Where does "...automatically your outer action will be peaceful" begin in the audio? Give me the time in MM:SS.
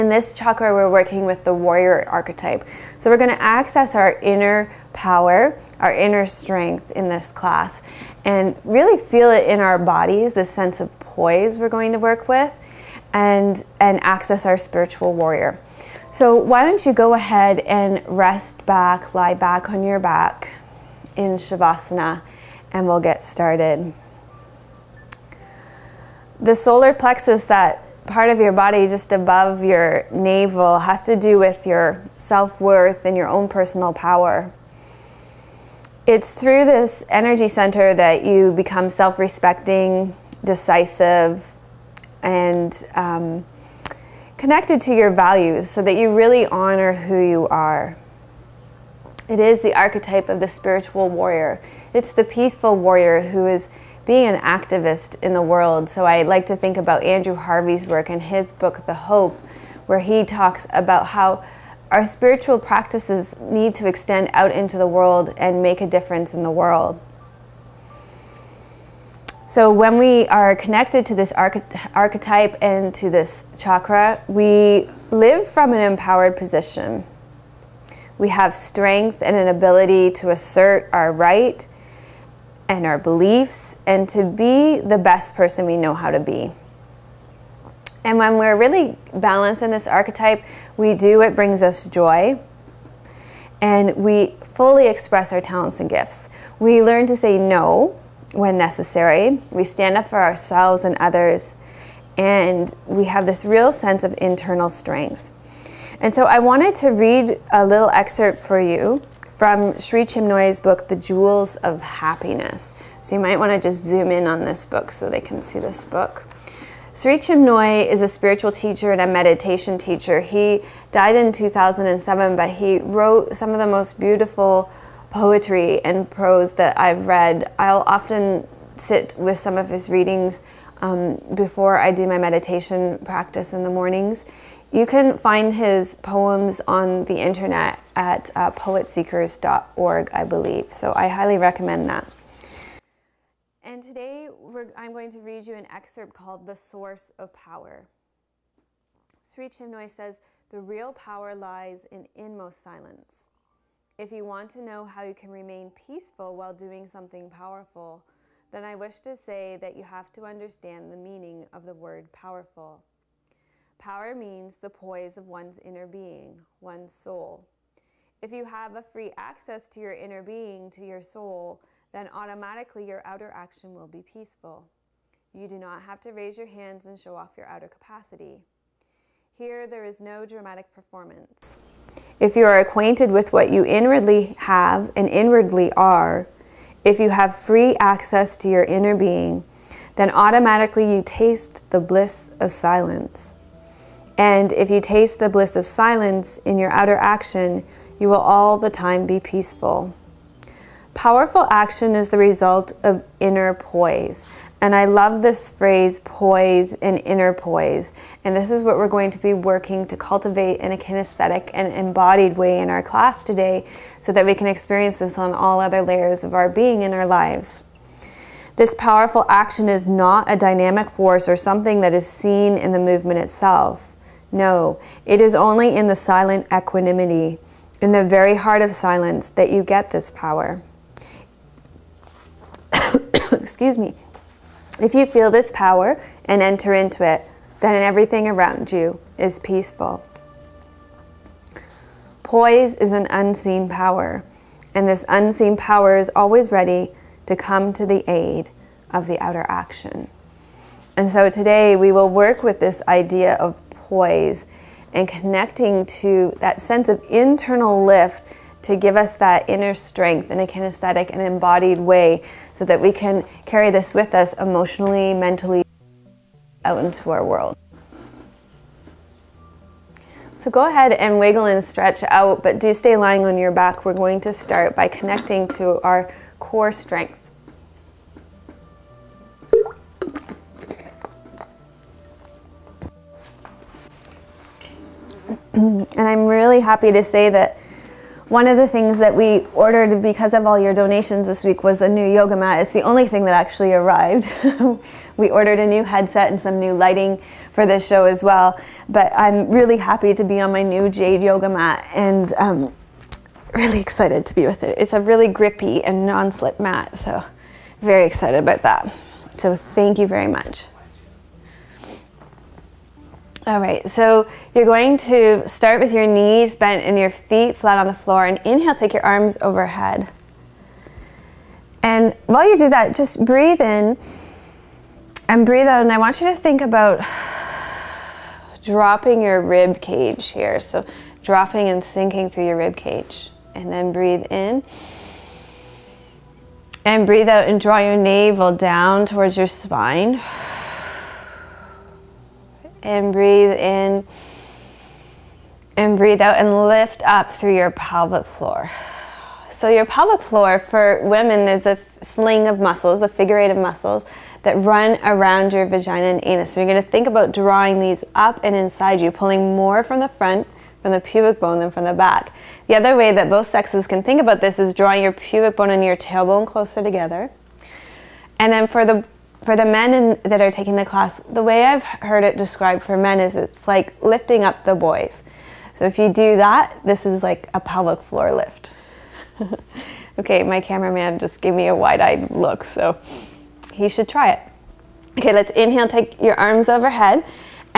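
02:52.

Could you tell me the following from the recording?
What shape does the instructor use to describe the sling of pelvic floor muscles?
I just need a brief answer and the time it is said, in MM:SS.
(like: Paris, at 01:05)
figure eight, at 05:53.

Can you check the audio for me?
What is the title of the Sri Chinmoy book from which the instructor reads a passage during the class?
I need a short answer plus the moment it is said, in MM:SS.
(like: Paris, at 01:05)
The Jewels of Happiness, at 01:50.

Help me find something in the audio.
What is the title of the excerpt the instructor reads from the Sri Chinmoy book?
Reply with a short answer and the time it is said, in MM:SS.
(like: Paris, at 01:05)
The Source of Power, at 02:26.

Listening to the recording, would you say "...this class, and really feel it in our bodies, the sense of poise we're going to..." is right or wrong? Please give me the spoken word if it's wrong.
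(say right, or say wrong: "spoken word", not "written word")
right.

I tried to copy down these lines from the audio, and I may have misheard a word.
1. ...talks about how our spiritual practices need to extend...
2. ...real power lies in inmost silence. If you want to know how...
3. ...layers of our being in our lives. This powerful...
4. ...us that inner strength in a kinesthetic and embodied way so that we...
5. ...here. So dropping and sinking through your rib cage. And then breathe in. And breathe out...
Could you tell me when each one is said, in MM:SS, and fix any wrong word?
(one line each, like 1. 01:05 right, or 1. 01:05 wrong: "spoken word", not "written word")
1. 01:00 right
2. 02:30 right
3. 03:35 right
4. 04:18 right
5. 05:30 right.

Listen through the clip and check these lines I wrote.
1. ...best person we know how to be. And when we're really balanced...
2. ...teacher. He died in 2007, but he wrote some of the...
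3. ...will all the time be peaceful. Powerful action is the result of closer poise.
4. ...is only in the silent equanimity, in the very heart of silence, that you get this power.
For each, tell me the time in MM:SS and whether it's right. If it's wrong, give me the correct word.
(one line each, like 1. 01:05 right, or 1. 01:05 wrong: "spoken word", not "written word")
1. 01:24 right
2. 01:59 right
3. 03:18 wrong: "inner", not "closer"
4. 03:45 right.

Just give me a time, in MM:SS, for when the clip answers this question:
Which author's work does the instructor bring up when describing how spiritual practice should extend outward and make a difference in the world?
00:57.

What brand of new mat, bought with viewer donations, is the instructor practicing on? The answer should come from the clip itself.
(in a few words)
Jade.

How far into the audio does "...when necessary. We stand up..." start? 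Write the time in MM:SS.
01:38.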